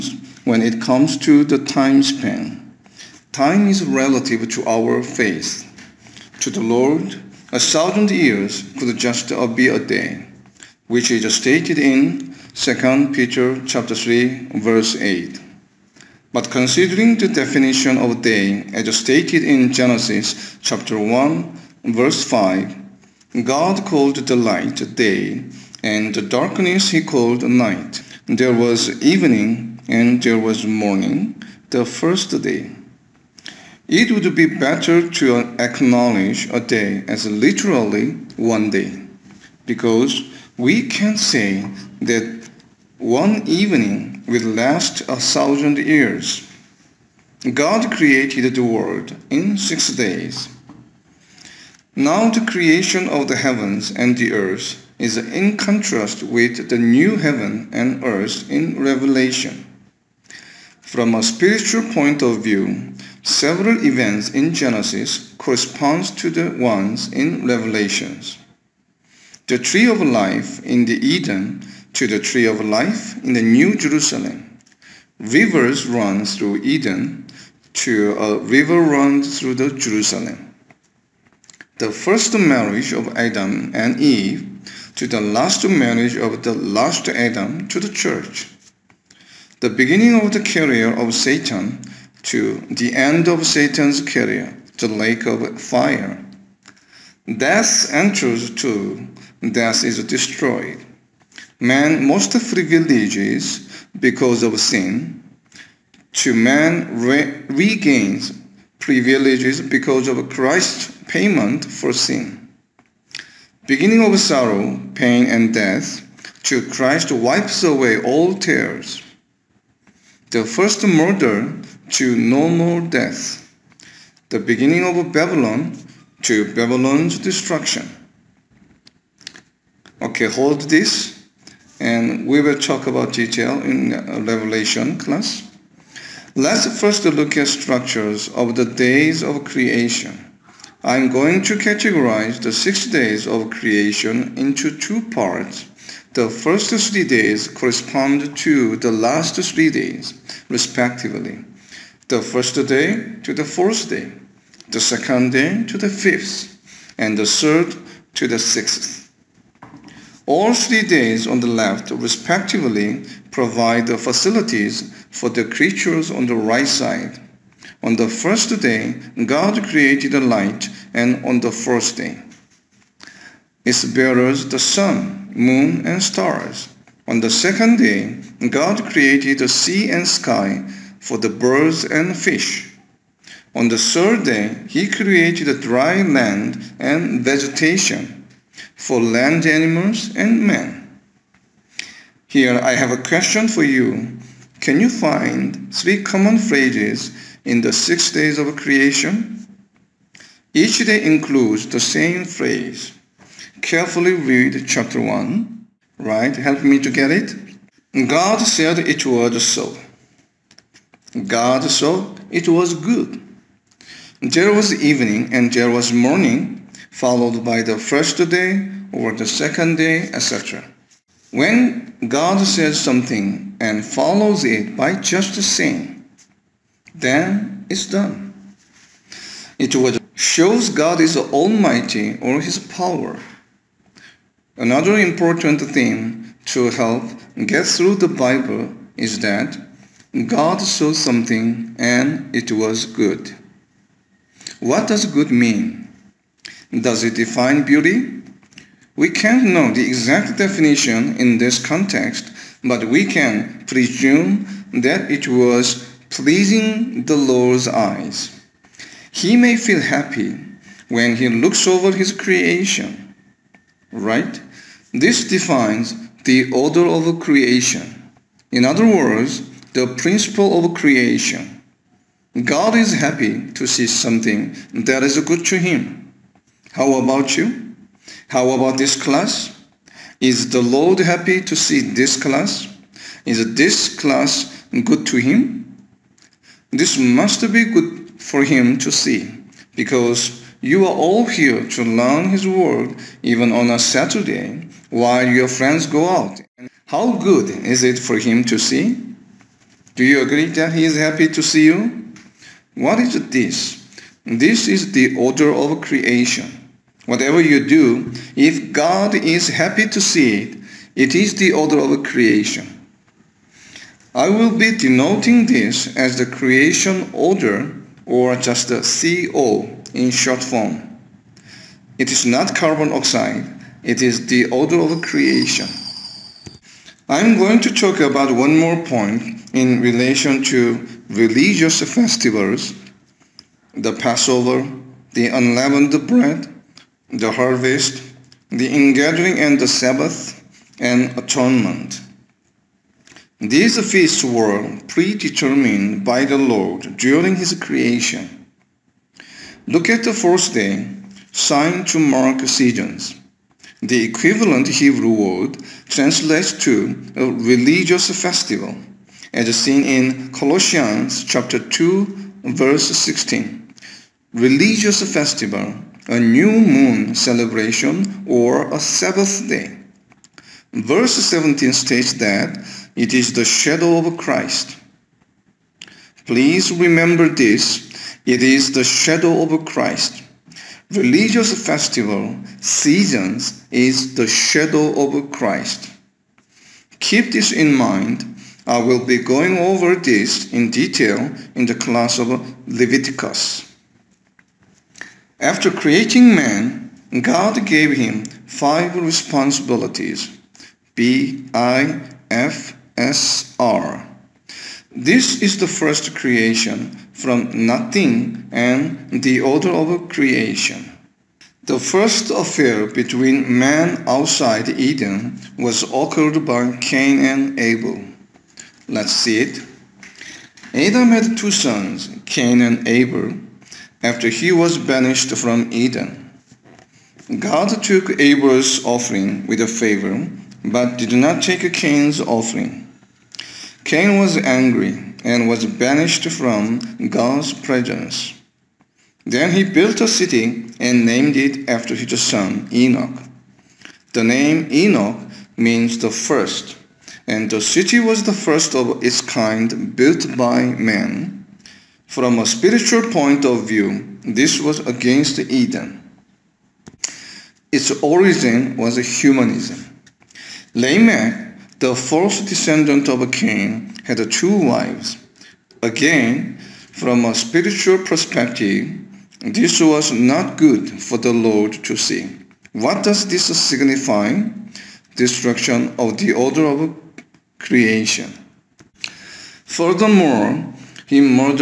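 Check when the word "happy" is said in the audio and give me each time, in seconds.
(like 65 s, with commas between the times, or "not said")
259 s, 272 s, 280 s, 300 s, 309 s.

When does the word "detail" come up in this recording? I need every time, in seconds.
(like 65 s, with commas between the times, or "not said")
133 s, 390 s.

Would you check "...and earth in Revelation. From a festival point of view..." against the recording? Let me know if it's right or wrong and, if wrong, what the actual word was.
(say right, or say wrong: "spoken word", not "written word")
wrong: "spiritual", not "festival".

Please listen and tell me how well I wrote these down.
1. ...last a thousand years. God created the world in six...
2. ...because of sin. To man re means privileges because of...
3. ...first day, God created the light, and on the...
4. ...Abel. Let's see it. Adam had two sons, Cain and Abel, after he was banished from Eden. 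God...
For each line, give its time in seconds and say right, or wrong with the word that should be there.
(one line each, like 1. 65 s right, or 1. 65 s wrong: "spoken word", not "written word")
1. 44 s right
2. 103 s wrong: "regains", not "means"
3. 168 s right
4. 417 s right.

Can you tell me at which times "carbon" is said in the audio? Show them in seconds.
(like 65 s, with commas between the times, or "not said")
322 s.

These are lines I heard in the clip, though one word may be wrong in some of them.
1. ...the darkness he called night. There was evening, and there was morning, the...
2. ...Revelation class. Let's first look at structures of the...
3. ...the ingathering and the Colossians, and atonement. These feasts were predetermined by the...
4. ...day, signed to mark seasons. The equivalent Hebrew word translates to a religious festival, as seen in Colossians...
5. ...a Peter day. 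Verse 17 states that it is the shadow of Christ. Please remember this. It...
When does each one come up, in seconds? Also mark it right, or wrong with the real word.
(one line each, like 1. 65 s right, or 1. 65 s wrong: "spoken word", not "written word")
1. 26 s right
2. 134 s right
3. 338 s wrong: "Sabbath", not "Colossians"
4. 350 s right
5. 368 s wrong: "Sabbath", not "Peter".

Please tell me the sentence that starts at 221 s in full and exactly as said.
When God says something and follows it by just the same, then it's done.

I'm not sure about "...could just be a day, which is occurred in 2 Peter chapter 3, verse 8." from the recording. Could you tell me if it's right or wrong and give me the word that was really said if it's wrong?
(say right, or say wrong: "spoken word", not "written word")
wrong: "stated", not "occurred".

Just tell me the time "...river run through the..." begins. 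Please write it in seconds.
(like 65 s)
78 s.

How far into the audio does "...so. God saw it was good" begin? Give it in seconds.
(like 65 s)
209 s.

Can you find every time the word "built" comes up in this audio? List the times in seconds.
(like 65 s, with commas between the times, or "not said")
439 s, 449 s.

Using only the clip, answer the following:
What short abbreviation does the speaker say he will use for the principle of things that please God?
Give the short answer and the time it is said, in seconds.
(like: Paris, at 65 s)
CO, at 318 s.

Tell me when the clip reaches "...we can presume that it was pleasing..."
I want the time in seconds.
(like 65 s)
252 s.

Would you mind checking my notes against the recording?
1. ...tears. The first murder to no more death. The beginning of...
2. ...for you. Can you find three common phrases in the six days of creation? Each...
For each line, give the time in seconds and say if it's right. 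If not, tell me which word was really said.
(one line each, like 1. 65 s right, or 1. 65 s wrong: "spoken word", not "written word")
1. 118 s right
2. 193 s right.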